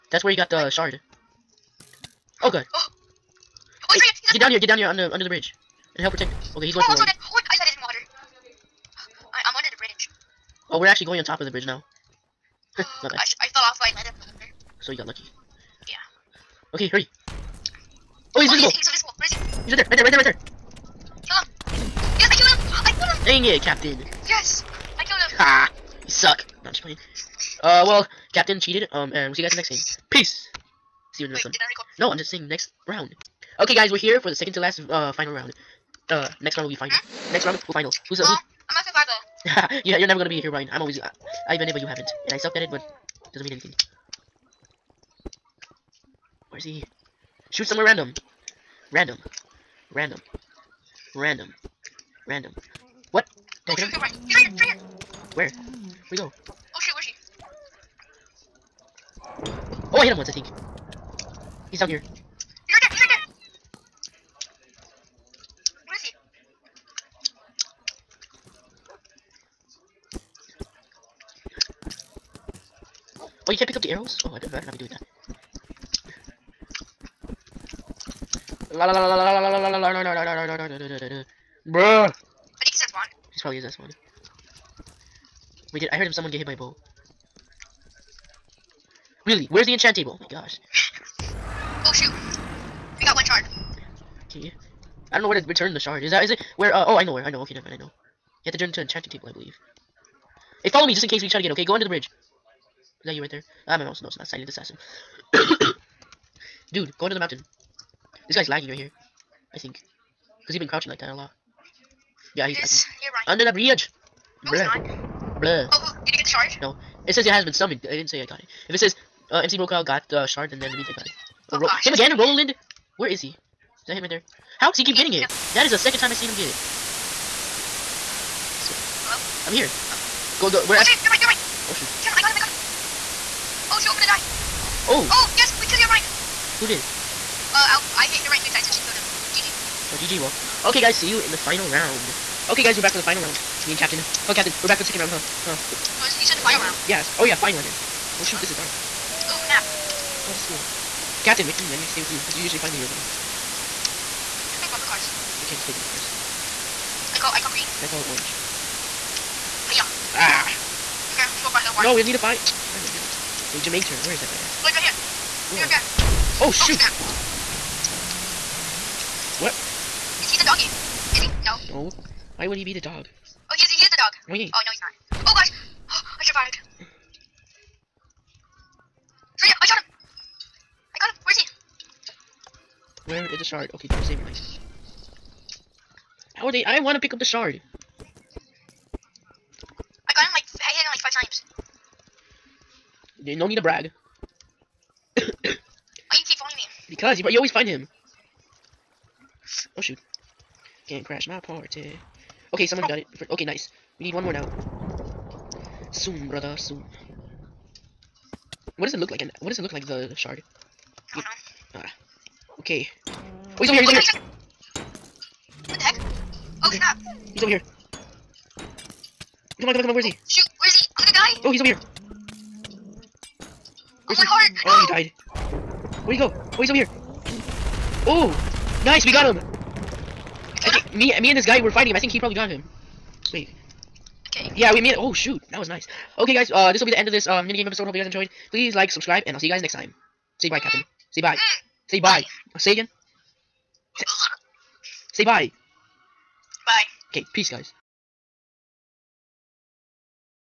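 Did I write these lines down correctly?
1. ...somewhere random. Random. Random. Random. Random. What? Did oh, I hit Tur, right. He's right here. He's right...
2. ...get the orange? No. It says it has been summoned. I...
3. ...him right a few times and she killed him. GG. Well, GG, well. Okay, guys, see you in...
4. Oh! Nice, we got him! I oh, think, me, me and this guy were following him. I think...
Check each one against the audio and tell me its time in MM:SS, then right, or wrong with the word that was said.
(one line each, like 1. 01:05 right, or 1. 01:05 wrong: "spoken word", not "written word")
1. 00:47 wrong: "Shoot", not "Tur"
2. 01:56 wrong: "charge", not "orange"
3. 02:18 right
4. 03:48 wrong: "fighting", not "following".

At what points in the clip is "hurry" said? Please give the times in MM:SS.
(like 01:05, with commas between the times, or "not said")
00:16.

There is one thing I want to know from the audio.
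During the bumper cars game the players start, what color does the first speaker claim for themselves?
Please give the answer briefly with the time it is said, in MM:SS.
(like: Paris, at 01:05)
Green, at 02:37.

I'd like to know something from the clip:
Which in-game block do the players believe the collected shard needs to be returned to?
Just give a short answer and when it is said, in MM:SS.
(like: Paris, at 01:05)
Enchanting table, at 01:38.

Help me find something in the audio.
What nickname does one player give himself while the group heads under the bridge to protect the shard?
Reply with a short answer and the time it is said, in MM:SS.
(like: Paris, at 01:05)
Silent assassin, at 01:44.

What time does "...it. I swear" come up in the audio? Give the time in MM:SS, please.
02:06.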